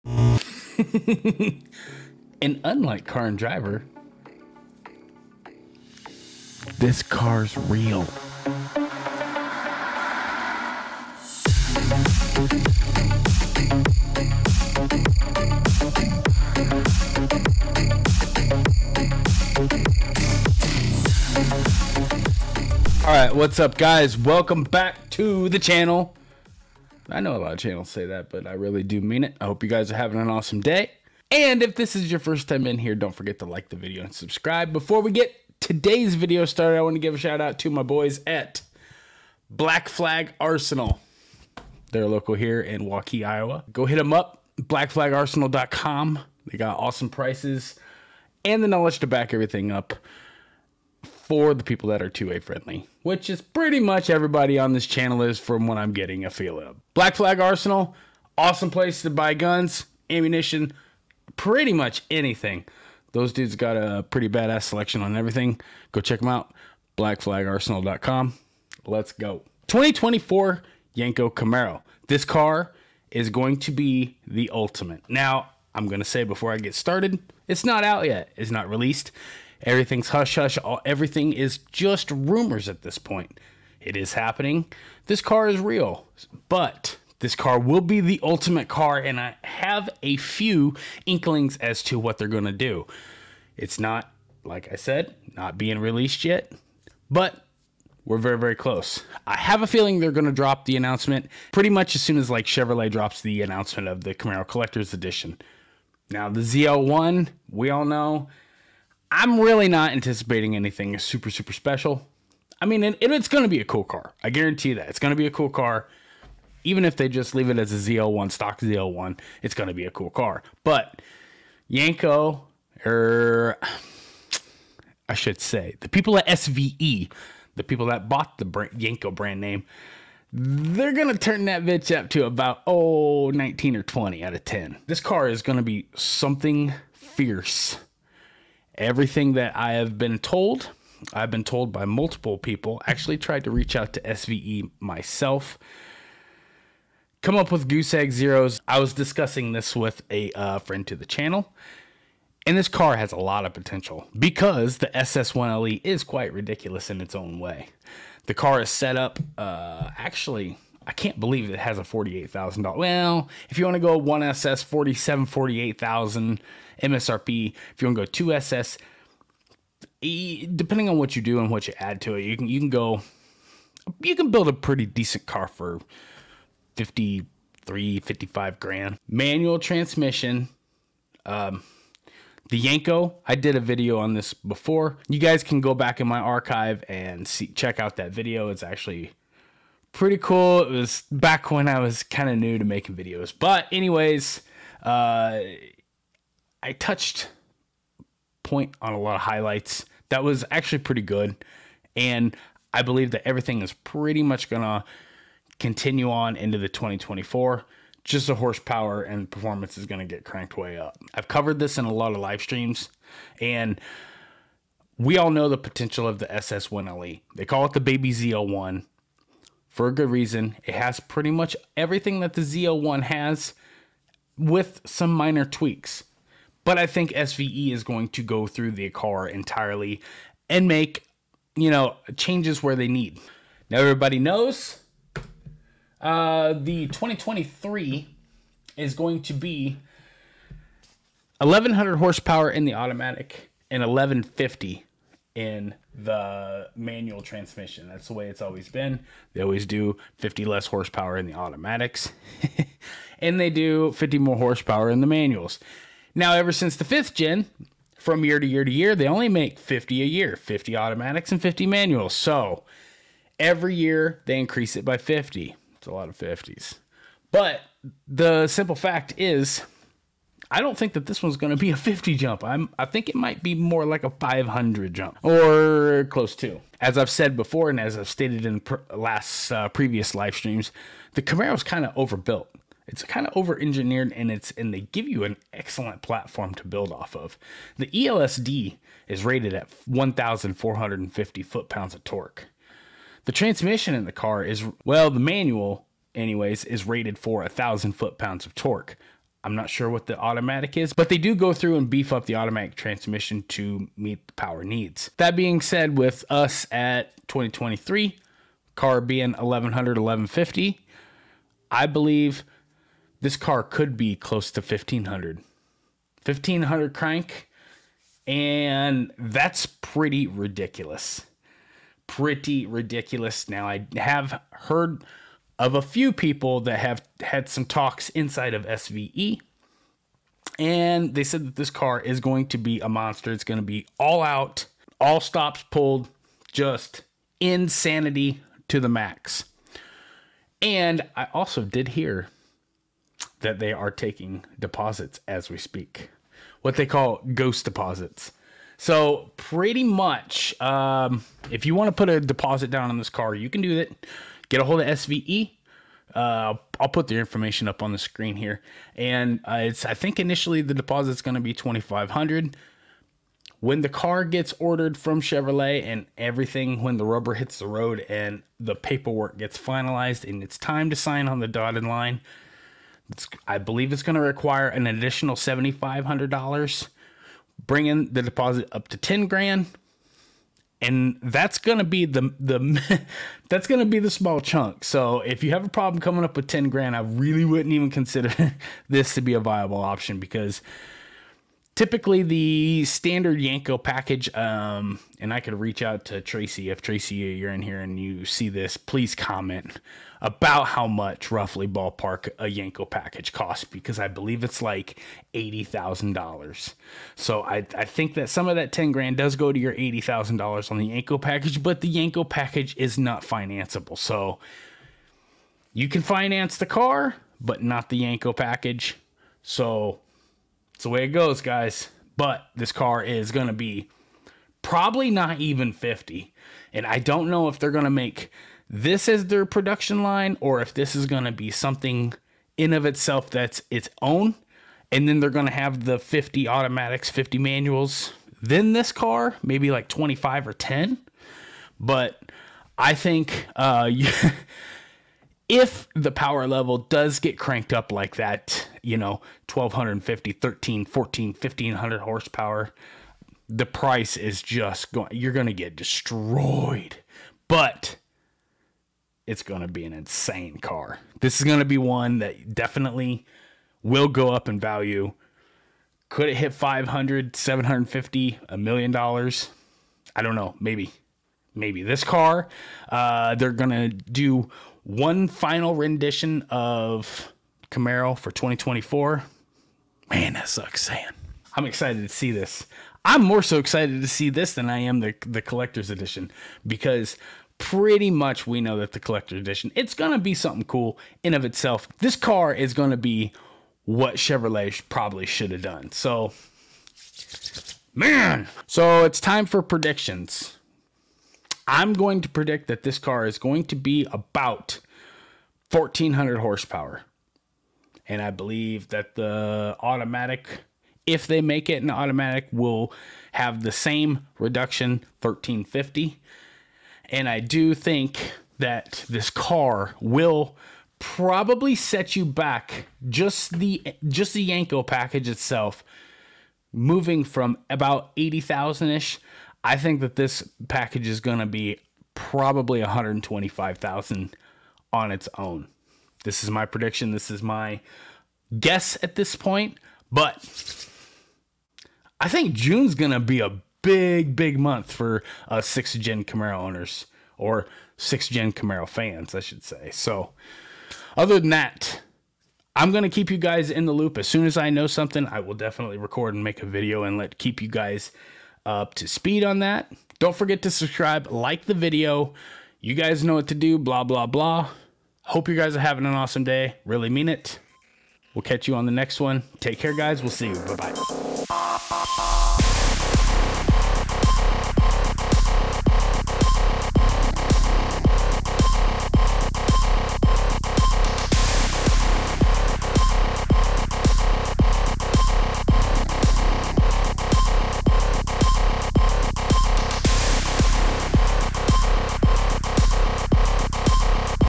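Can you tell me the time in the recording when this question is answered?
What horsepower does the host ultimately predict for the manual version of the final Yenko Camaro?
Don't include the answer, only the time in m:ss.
8:25.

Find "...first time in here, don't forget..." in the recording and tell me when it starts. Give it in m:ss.
0:32.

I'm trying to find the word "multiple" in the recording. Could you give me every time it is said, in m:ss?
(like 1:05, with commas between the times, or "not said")
2:21.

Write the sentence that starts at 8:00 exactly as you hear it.
Man, that sucks, Saying I'm excited to see this.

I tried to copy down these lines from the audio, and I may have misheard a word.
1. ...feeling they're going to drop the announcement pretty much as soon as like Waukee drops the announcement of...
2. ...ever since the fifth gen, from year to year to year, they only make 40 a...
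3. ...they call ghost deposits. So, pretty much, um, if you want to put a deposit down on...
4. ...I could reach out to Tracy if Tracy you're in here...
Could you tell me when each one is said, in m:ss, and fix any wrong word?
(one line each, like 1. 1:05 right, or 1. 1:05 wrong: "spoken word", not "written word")
1. 1:39 wrong: "Chevrolet", not "Waukee"
2. 4:16 wrong: "50", not "40"
3. 5:46 right
4. 6:35 right.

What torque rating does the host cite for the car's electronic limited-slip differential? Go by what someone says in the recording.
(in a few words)
1,450 foot pounds.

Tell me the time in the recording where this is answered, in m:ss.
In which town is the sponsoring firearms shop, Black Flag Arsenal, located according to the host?
0:42.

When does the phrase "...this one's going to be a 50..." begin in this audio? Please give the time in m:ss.
4:31.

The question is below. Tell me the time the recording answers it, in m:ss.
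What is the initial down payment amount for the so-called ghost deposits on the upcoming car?
6:01.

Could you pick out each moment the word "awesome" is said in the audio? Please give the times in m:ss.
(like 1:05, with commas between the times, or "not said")
0:30, 0:46, 0:58, 9:26.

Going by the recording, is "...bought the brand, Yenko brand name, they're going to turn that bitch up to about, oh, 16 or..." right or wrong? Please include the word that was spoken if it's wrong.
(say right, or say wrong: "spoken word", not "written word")
wrong: "19", not "16".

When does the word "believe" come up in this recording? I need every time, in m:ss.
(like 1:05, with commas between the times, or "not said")
2:41, 3:22, 5:11, 6:13, 6:44, 8:28.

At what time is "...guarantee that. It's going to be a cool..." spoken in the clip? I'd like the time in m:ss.
1:54.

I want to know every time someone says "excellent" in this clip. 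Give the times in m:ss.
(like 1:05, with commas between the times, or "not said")
4:45.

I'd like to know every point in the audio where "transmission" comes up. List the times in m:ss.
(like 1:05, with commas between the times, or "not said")
2:59, 4:07, 4:53, 5:02.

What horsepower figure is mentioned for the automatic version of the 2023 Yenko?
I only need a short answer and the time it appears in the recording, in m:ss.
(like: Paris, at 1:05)
1100, at 4:01.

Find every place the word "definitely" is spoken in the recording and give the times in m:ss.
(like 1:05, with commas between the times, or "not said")
7:42, 9:15.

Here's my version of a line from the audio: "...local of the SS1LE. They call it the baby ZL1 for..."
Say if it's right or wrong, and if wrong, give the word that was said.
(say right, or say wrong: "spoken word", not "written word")
wrong: "potential", not "local".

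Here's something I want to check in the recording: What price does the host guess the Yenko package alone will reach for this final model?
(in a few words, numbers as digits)
$125,000.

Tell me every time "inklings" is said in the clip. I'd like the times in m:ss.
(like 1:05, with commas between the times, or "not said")
1:31.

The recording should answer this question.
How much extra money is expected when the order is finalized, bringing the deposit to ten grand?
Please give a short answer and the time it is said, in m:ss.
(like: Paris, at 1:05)
$7,500, at 6:15.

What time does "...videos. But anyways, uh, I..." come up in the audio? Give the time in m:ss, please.
3:12.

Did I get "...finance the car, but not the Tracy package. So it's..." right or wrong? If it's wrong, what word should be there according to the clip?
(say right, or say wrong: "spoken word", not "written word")
wrong: "Yenko", not "Tracy".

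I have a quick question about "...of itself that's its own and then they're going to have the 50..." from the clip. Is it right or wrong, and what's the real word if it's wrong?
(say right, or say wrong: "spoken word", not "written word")
right.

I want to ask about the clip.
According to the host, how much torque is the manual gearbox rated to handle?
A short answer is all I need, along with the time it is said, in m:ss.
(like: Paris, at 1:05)
1,000 foot pounds, at 4:57.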